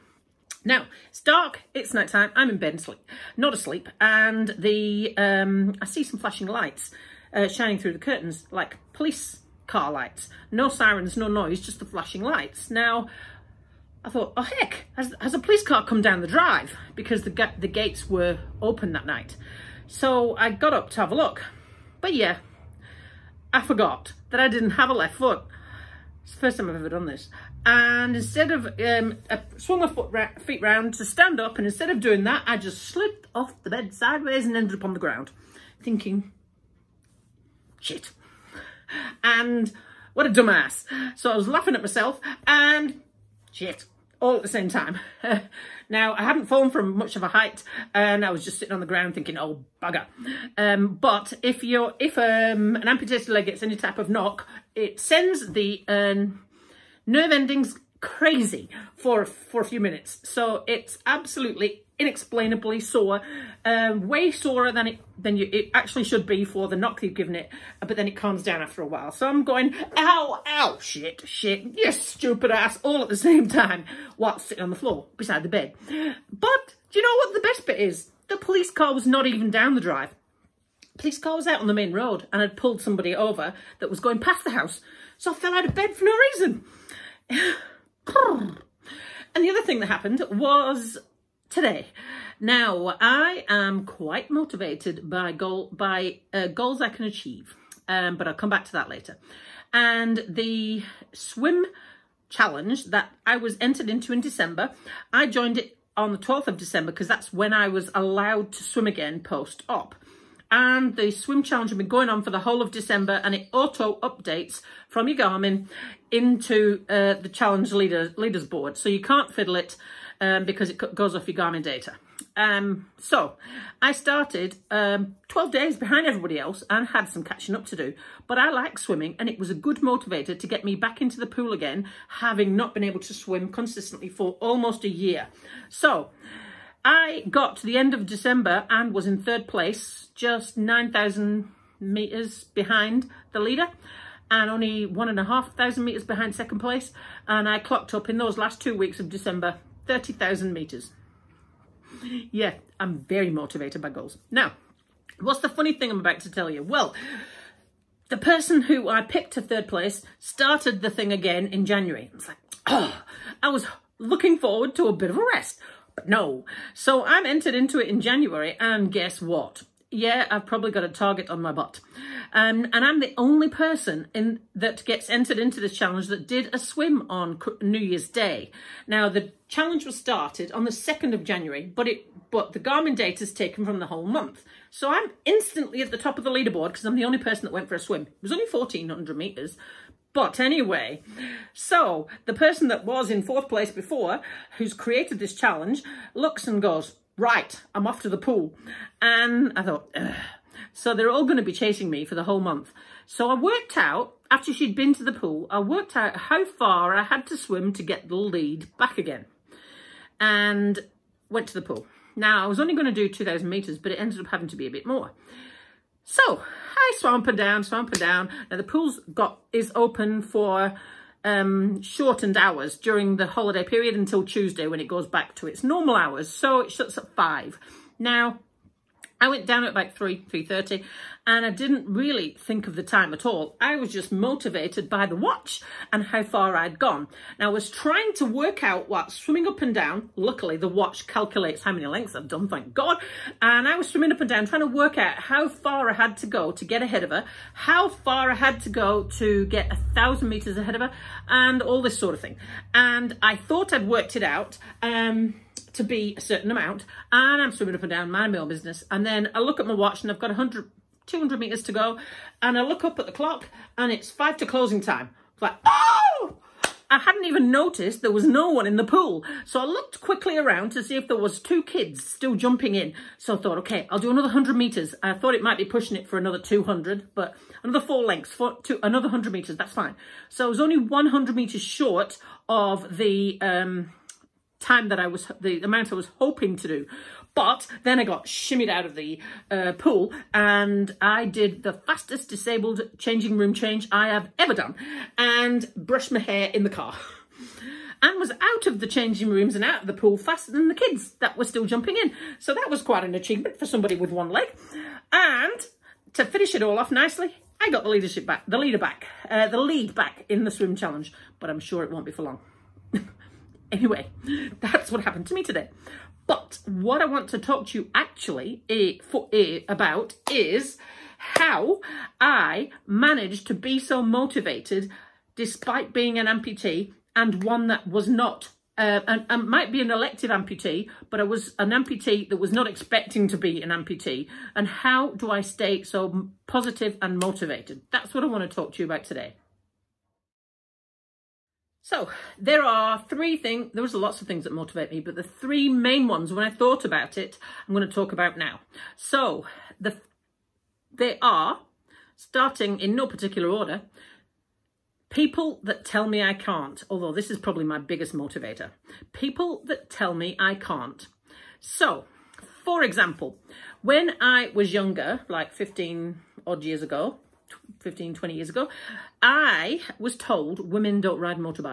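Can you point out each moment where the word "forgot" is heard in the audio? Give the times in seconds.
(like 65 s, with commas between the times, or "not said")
23 s.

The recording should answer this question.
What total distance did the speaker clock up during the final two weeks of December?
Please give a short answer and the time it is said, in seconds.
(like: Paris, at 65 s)
30,000 meters, at 149 s.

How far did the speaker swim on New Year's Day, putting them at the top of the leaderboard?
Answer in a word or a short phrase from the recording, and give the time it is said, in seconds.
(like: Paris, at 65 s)
1,400 metres, at 188 s.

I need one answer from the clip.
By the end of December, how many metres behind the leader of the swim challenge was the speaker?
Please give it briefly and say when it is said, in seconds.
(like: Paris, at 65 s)
9,000 metres, at 140 s.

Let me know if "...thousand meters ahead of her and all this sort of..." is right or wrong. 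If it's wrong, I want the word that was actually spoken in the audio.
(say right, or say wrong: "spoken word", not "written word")
right.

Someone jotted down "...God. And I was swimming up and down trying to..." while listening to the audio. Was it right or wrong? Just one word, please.
right.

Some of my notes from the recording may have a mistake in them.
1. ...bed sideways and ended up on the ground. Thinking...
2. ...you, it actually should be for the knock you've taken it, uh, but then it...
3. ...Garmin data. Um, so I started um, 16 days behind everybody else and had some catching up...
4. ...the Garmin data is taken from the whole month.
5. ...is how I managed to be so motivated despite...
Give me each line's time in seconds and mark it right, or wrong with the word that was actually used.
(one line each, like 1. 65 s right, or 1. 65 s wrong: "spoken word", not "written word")
1. 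33 s right
2. 65 s wrong: "given", not "taken"
3. 121 s wrong: "12", not "16"
4. 182 s right
5. 320 s right.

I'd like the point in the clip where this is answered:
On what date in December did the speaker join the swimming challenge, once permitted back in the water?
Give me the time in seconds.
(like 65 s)
106 s.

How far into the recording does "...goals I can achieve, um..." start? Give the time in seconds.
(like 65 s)
96 s.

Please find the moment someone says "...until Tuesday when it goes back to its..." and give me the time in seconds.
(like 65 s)
223 s.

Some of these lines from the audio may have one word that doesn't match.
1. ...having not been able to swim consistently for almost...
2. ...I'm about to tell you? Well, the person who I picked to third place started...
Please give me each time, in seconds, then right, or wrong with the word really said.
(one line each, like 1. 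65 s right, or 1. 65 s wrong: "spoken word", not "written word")
1. 132 s right
2. 155 s right.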